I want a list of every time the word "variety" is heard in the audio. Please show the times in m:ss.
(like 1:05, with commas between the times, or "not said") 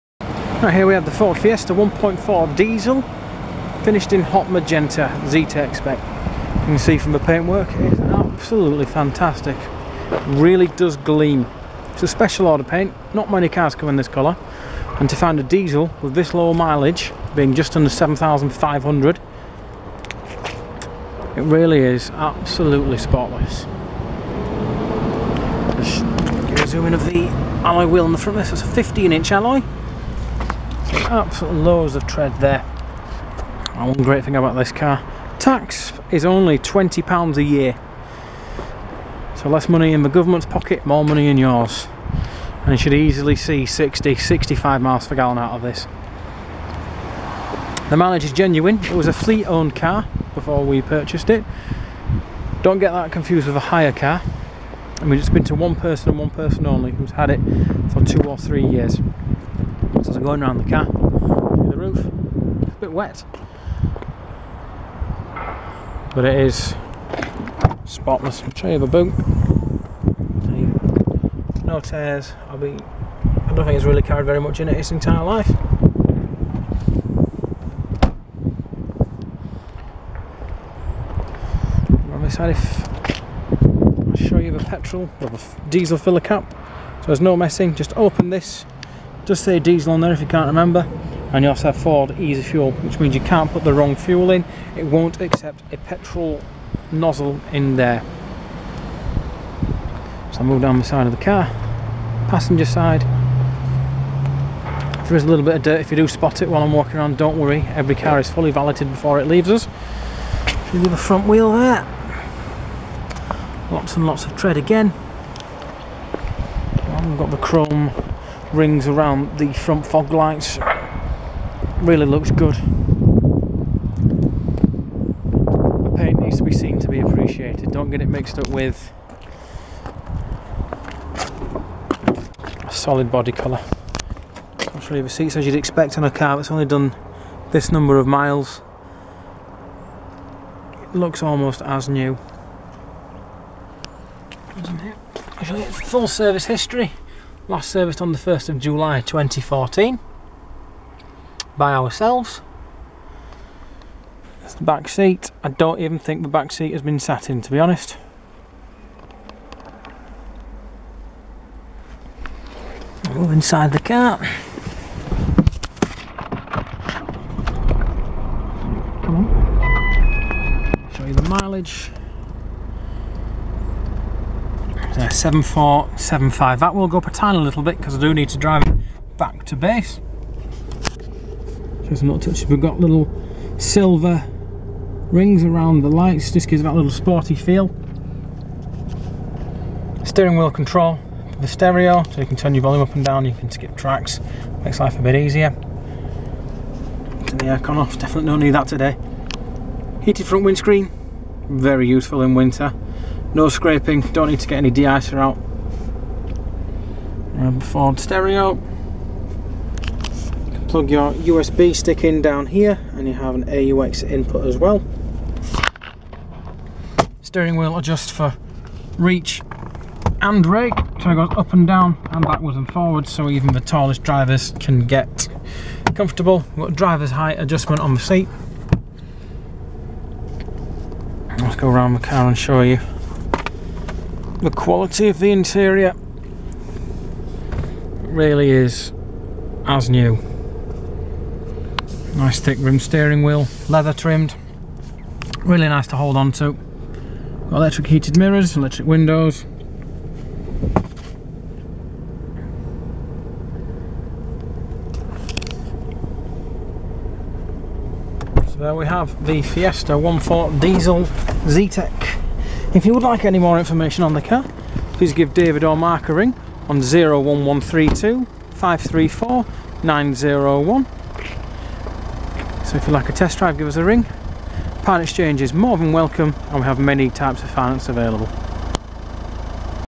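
not said.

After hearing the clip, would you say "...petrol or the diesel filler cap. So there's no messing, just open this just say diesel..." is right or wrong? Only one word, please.
right.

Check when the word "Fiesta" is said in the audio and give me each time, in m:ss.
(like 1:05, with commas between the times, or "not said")
0:01, 4:19.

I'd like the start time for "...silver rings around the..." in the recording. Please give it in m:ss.
3:03.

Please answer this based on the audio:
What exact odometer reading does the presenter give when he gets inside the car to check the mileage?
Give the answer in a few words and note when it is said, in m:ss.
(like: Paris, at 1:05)
7475, at 2:55.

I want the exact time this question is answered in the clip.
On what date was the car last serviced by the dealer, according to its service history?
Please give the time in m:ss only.
2:28.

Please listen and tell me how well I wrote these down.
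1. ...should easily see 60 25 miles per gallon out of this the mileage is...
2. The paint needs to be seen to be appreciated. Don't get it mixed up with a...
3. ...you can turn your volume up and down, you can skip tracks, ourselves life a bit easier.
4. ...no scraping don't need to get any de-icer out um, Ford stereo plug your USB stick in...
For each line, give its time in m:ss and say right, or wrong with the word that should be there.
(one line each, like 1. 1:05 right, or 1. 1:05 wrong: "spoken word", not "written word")
1. 0:42 wrong: "65", not "25"
2. 2:02 right
3. 3:12 wrong: "makes", not "ourselves"
4. 3:23 right.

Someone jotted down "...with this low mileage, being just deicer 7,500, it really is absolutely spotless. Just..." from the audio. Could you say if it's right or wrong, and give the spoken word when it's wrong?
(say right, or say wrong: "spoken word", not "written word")
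wrong: "under", not "deicer".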